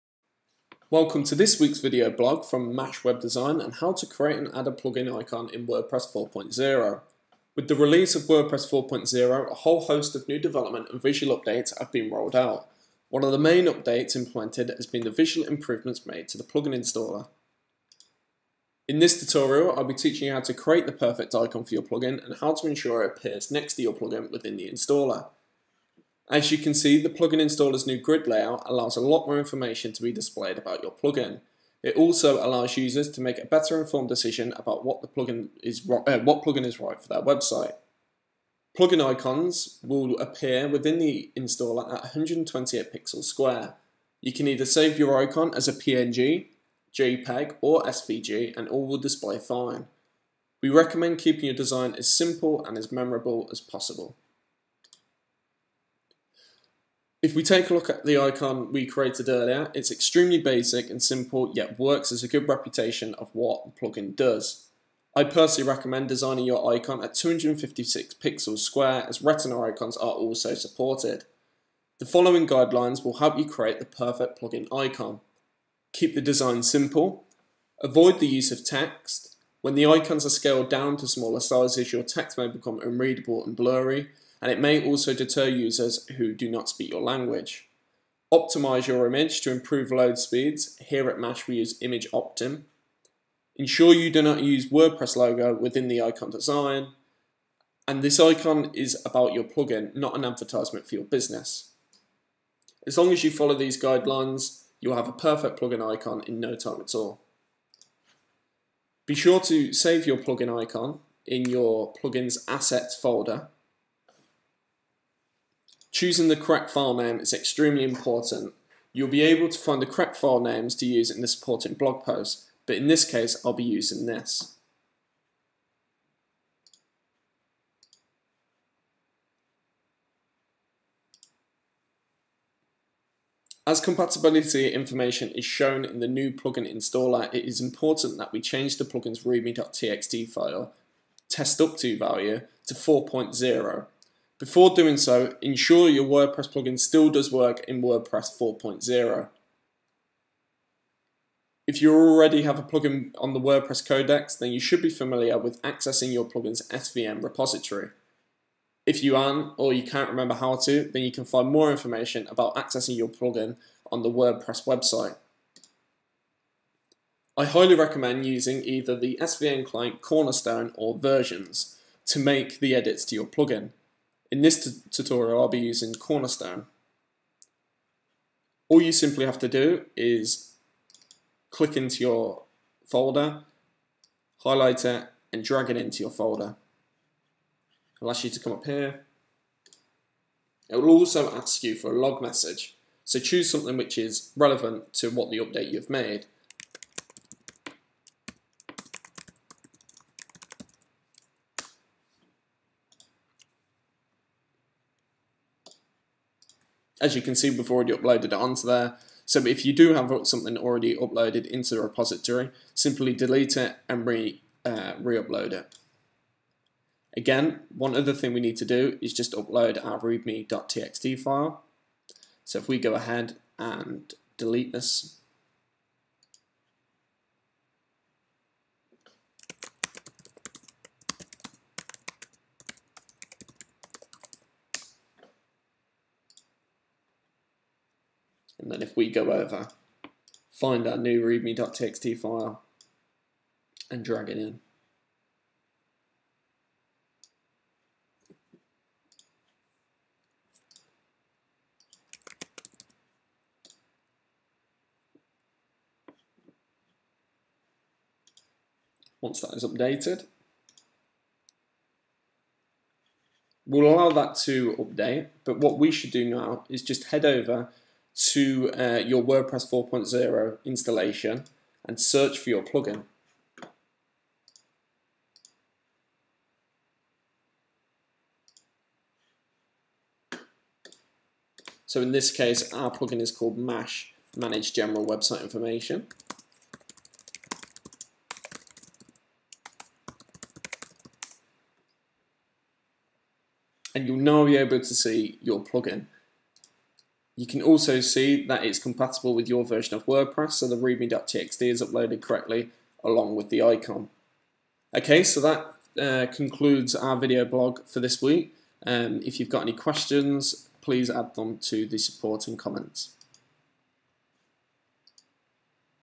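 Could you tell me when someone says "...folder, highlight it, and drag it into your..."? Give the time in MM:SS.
03:02.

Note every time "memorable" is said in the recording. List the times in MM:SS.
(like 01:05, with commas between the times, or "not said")
00:52.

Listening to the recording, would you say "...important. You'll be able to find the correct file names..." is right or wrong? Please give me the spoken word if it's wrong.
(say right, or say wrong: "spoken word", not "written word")
right.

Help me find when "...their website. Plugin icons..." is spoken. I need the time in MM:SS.
00:37.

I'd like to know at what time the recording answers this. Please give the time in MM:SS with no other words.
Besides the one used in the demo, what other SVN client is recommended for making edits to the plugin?
02:50.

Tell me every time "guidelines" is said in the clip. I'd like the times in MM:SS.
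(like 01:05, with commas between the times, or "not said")
01:12, 01:43.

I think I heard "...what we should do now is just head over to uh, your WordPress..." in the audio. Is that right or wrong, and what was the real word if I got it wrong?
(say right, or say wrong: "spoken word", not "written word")
right.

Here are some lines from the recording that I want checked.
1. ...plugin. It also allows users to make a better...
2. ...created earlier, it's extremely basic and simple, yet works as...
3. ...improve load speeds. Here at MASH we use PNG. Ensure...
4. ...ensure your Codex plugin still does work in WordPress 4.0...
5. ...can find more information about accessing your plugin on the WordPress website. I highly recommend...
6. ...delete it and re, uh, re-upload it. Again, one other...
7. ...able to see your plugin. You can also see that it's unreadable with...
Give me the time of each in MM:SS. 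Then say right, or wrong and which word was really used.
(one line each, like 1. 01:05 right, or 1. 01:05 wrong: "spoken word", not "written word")
1. 00:30 right
2. 00:58 right
3. 01:29 wrong: "ImageOptim", not "PNG"
4. 02:25 wrong: "WordPress", not "Codex"
5. 02:41 right
6. 03:33 right
7. 04:54 wrong: "compatible", not "unreadable".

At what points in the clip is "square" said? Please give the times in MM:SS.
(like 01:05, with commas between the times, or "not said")
00:43, 01:08.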